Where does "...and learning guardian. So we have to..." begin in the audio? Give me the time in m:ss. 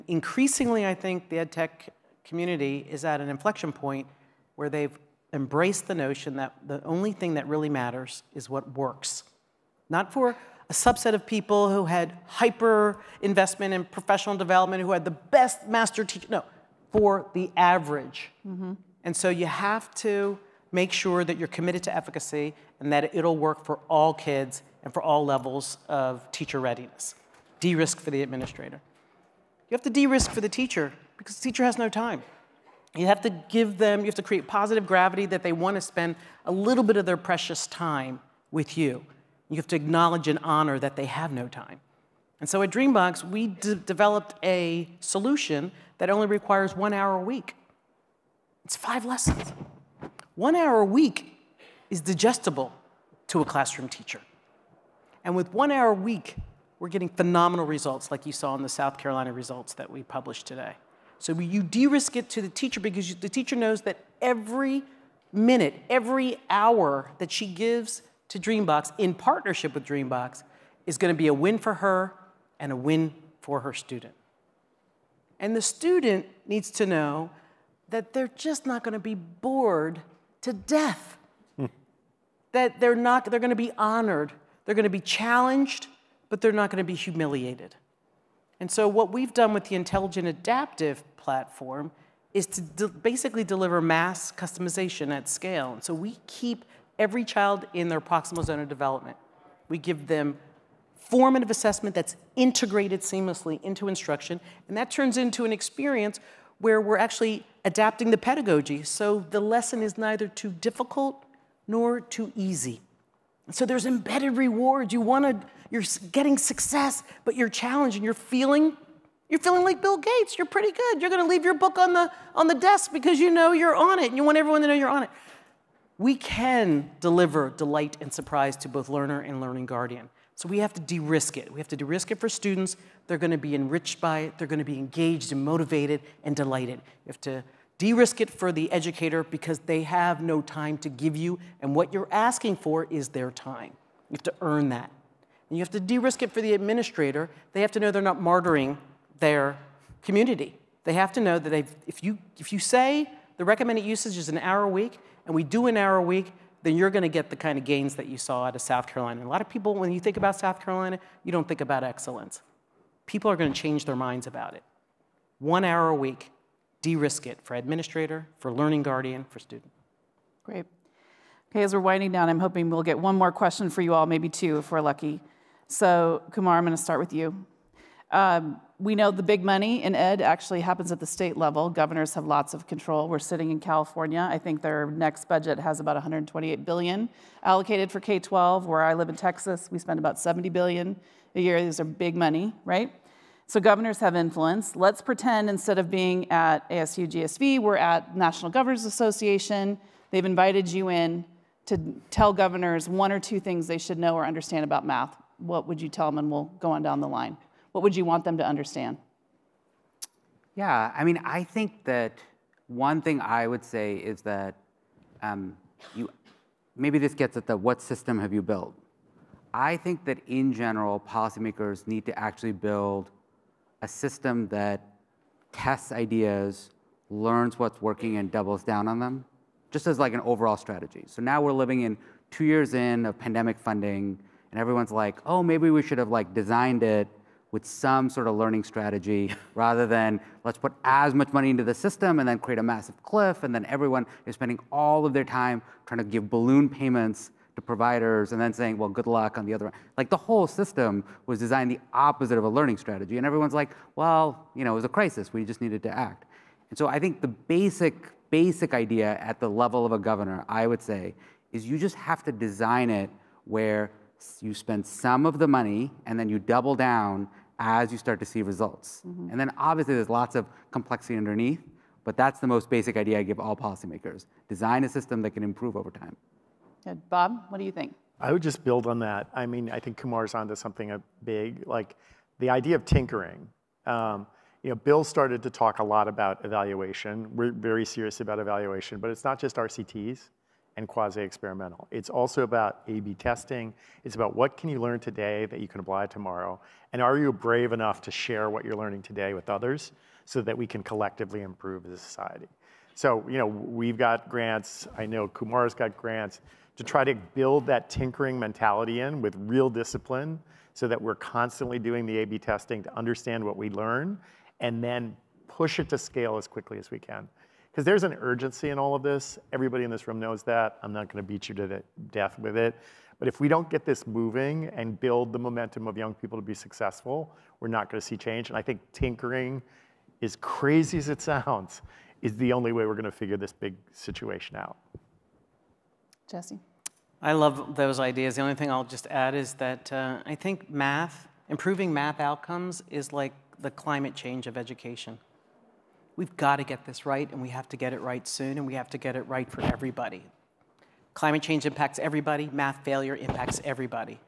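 2:09.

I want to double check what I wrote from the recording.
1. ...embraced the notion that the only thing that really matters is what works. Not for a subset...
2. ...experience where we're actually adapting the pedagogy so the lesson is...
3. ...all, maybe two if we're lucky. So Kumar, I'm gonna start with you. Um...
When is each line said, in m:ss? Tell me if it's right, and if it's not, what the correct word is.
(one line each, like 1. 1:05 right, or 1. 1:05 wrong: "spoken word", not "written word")
1. 0:05 right
2. 1:45 right
3. 2:53 right.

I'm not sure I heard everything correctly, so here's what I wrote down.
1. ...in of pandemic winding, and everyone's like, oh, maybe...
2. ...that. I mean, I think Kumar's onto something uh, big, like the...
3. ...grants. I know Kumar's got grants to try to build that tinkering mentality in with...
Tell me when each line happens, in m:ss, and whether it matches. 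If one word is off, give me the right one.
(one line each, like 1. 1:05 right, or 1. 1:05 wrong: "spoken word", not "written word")
1. 3:52 wrong: "funding", not "winding"
2. 4:38 right
3. 5:04 right.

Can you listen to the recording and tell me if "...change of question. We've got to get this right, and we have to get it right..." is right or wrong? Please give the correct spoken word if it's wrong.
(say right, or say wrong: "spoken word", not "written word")
wrong: "education", not "question".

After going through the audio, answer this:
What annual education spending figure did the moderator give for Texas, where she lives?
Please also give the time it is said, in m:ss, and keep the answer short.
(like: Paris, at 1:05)
70 billion, at 3:10.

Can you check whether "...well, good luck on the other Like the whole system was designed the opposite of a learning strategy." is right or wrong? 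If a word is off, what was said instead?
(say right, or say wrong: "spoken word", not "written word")
right.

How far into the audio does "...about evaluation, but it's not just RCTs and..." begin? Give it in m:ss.
4:48.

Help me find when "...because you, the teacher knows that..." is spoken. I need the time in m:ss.
1:02.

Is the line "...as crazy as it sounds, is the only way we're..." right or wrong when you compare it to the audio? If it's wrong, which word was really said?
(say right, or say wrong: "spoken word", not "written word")
right.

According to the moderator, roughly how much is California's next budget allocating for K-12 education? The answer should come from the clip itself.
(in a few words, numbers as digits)
128 billion.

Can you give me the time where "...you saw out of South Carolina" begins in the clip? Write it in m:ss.
2:38.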